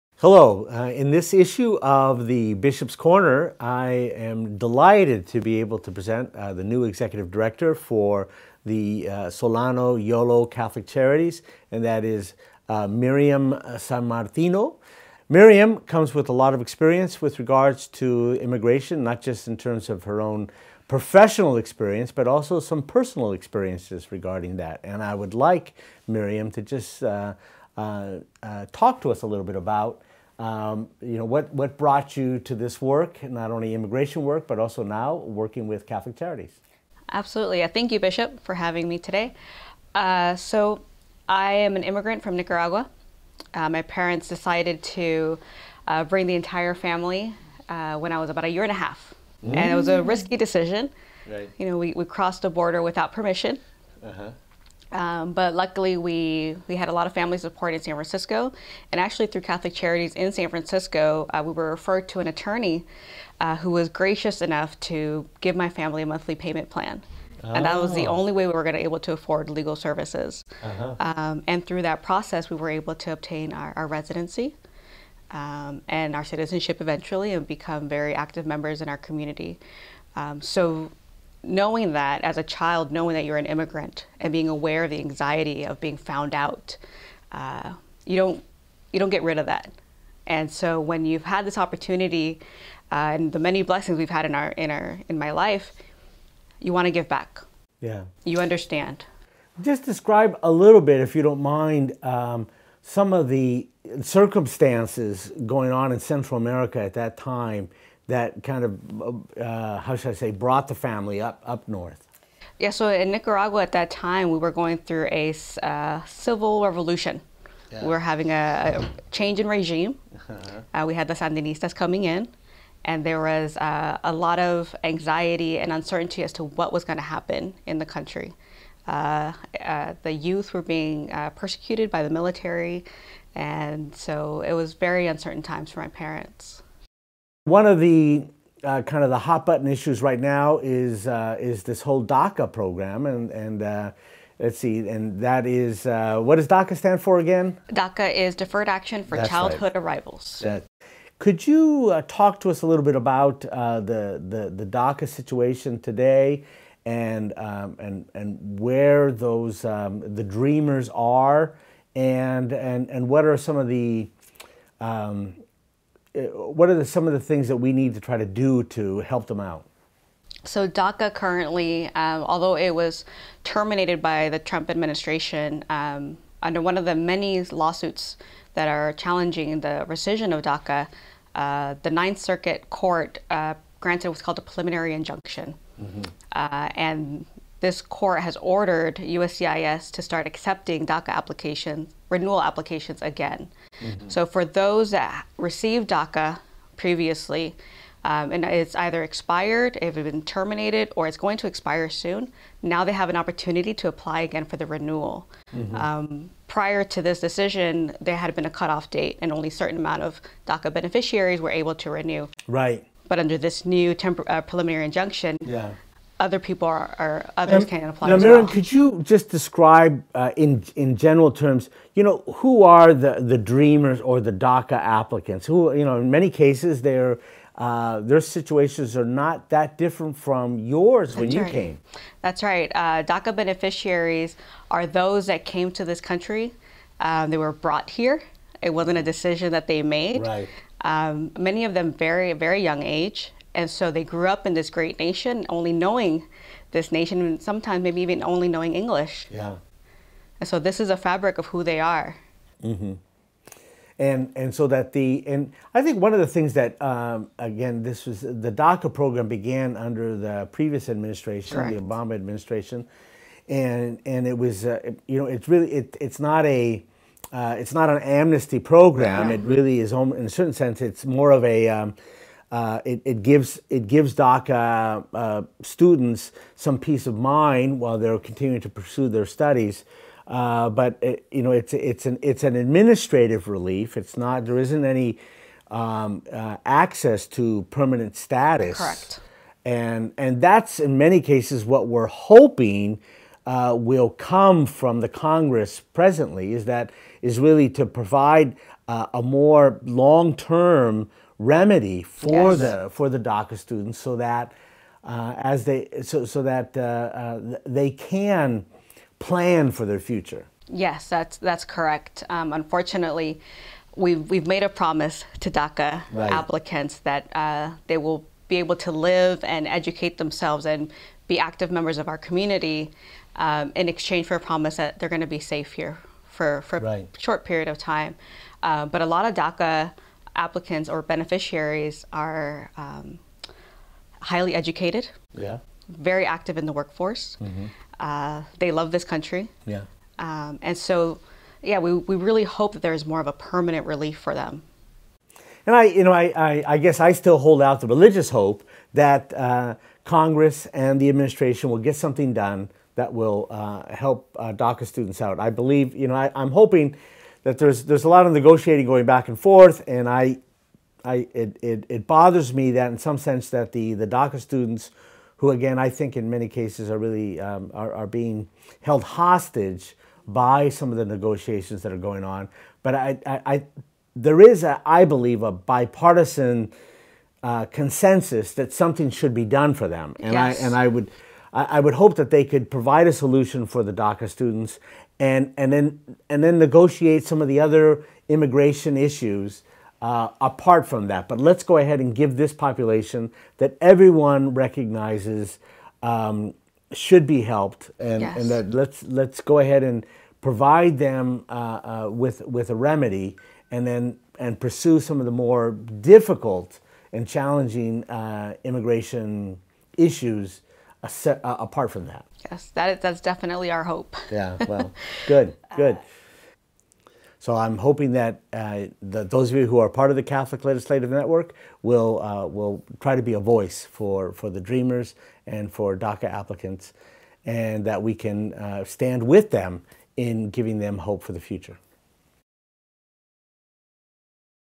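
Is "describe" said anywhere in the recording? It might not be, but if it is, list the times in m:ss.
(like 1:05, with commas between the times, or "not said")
1:39, 3:39.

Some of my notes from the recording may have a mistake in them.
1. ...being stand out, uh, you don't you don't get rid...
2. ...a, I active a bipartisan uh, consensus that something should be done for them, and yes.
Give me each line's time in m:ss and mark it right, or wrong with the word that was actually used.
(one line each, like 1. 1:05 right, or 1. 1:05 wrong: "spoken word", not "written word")
1. 1:25 wrong: "found", not "stand"
2. 6:14 wrong: "believe", not "active".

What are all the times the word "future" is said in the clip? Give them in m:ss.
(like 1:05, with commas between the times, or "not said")
5:09, 7:11.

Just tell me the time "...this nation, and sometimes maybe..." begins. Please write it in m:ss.
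4:06.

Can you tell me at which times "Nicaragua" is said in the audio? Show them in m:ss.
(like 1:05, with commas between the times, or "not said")
0:42, 1:53.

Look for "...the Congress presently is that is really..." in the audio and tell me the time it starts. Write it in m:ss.
4:54.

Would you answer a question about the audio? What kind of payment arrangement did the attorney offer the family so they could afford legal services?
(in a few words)
monthly payment plan.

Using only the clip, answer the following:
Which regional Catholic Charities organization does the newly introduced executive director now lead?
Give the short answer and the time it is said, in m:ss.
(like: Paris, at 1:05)
Solano Yolo Catholic Charities, at 0:09.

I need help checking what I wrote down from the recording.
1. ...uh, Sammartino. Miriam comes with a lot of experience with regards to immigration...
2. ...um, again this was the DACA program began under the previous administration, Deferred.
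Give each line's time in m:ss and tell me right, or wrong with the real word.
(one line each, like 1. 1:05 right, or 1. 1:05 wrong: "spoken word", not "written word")
1. 0:13 right
2. 4:16 wrong: "Correct", not "Deferred".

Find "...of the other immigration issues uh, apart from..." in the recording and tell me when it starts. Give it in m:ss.
6:27.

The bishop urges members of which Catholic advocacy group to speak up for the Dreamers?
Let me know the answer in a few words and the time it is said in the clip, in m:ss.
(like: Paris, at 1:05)
Catholic Legislative Network, at 7:00.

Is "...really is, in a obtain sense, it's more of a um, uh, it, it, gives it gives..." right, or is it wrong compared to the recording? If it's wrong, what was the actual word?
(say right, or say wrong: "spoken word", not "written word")
wrong: "certain", not "obtain".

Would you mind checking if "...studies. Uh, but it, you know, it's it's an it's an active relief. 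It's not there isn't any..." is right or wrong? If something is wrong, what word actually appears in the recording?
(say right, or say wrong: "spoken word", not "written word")
wrong: "administrative", not "active".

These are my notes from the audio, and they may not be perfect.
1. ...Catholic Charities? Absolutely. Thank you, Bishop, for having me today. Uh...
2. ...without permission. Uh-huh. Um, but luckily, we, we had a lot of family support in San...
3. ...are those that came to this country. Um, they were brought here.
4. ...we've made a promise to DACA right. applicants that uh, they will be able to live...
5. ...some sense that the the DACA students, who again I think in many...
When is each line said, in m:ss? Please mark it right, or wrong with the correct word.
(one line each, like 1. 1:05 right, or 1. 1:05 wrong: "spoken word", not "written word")
1. 0:35 right
2. 0:52 right
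3. 3:54 right
4. 5:14 right
5. 6:02 right.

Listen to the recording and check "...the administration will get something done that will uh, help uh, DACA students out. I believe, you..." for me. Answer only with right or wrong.
right.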